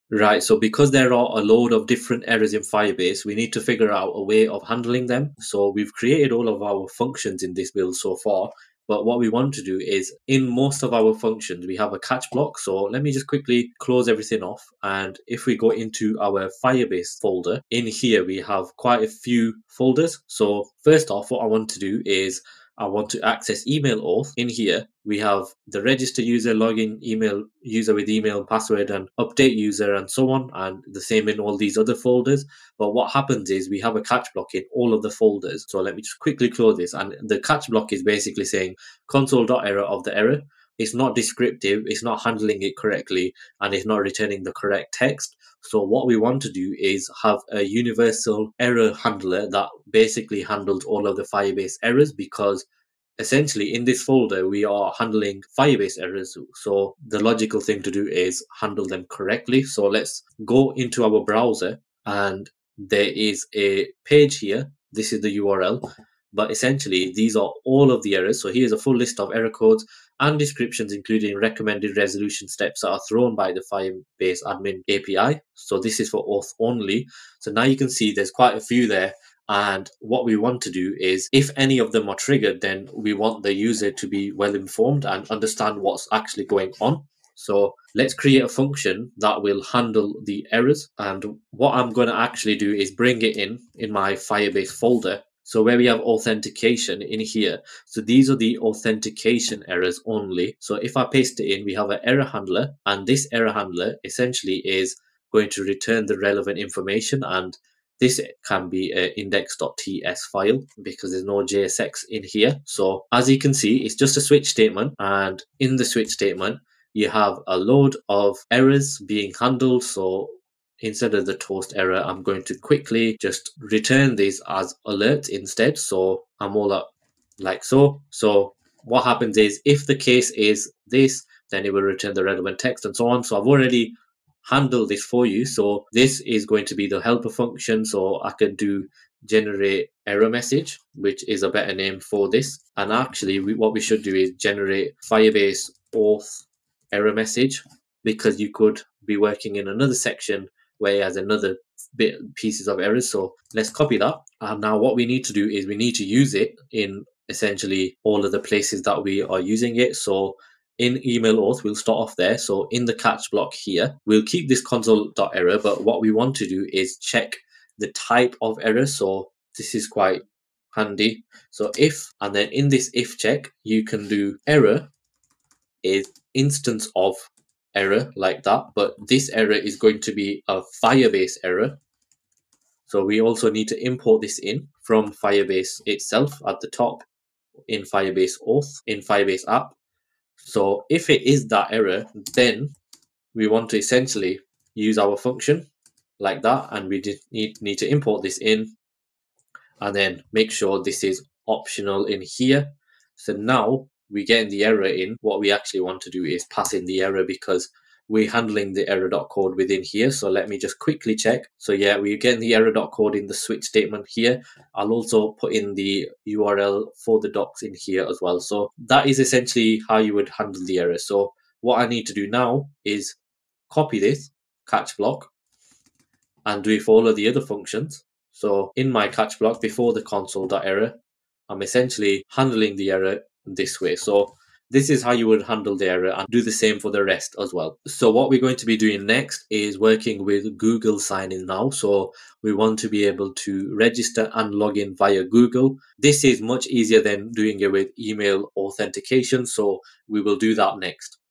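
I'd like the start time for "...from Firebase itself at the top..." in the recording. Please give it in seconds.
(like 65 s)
184 s.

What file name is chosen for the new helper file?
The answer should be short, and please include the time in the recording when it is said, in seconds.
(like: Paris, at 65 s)
index.ts, at 109 s.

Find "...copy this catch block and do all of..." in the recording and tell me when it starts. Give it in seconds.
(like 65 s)
223 s.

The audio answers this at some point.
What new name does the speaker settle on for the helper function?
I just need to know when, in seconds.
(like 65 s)
144 s.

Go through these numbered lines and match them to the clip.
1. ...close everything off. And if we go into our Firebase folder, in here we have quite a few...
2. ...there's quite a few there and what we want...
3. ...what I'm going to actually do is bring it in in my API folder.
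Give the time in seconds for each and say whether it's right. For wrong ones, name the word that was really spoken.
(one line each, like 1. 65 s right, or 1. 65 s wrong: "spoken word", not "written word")
1. 13 s right
2. 78 s right
3. 91 s wrong: "Firebase", not "API".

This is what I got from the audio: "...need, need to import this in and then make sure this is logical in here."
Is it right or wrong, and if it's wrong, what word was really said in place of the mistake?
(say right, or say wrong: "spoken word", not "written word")
wrong: "optional", not "logical".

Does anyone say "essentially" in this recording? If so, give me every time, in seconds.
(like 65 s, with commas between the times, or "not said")
53 s, 66 s, 104 s, 157 s, 193 s, 219 s, 231 s.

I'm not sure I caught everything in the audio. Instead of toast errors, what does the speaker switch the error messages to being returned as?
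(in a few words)
alerts.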